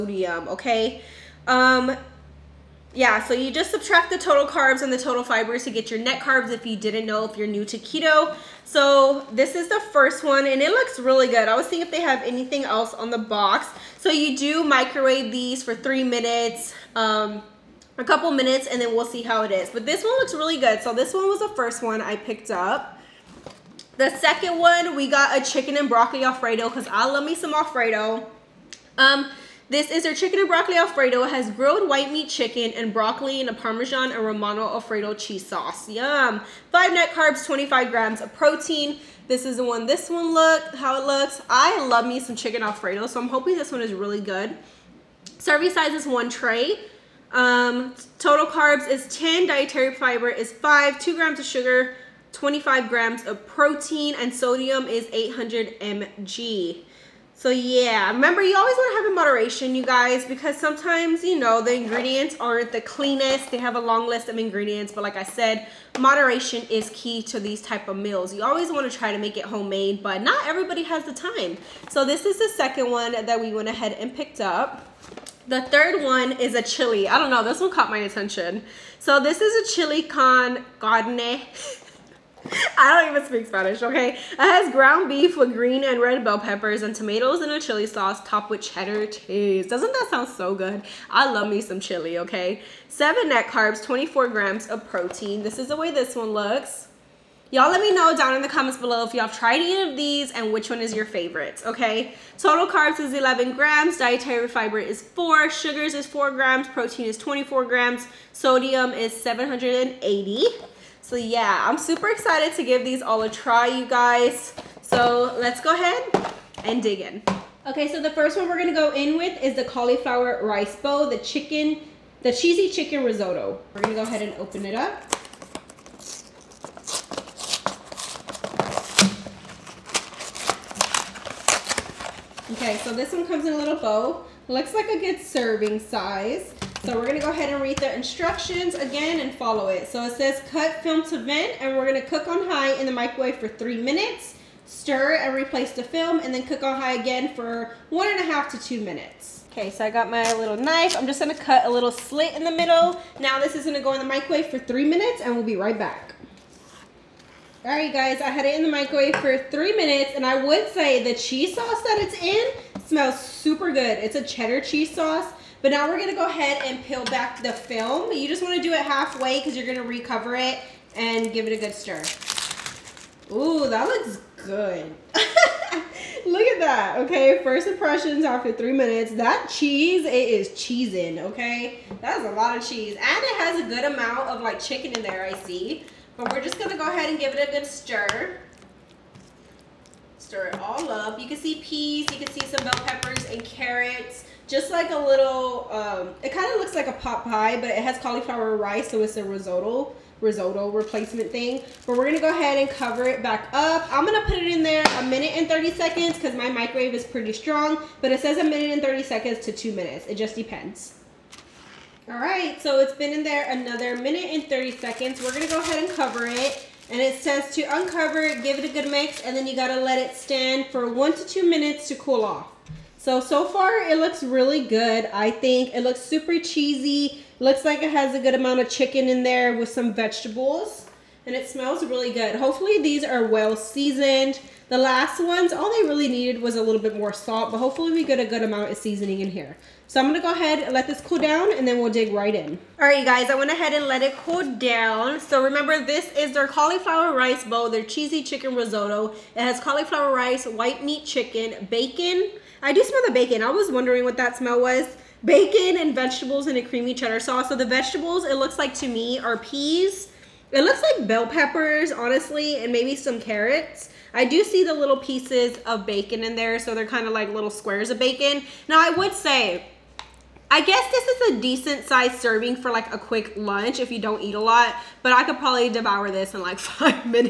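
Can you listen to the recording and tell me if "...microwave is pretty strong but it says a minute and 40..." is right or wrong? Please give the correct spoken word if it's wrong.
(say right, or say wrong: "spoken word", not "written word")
wrong: "30", not "40".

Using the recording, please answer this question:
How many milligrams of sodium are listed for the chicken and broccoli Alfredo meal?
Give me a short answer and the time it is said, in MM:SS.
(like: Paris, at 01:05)
800 mg, at 00:54.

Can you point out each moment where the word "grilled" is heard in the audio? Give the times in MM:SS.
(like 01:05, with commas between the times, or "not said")
00:31.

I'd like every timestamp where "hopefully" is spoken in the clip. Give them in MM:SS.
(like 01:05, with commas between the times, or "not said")
03:52, 03:57.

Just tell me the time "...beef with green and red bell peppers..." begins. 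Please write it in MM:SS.
01:25.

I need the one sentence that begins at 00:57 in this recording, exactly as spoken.
So yeah, remember you always want to have in moderation, you guys, because sometimes, you know, the ingredients aren't the cleanest.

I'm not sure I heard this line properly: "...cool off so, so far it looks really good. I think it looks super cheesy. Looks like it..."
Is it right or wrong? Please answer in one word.
right.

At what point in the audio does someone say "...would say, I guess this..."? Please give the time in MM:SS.
04:28.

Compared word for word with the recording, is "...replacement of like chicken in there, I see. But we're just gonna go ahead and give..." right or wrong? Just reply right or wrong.
wrong.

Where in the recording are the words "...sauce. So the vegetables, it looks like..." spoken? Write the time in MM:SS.
04:17.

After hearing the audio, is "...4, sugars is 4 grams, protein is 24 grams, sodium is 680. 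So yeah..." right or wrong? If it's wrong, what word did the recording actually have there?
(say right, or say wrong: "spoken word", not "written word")
wrong: "780", not "680".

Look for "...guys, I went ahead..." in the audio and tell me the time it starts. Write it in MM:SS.
04:03.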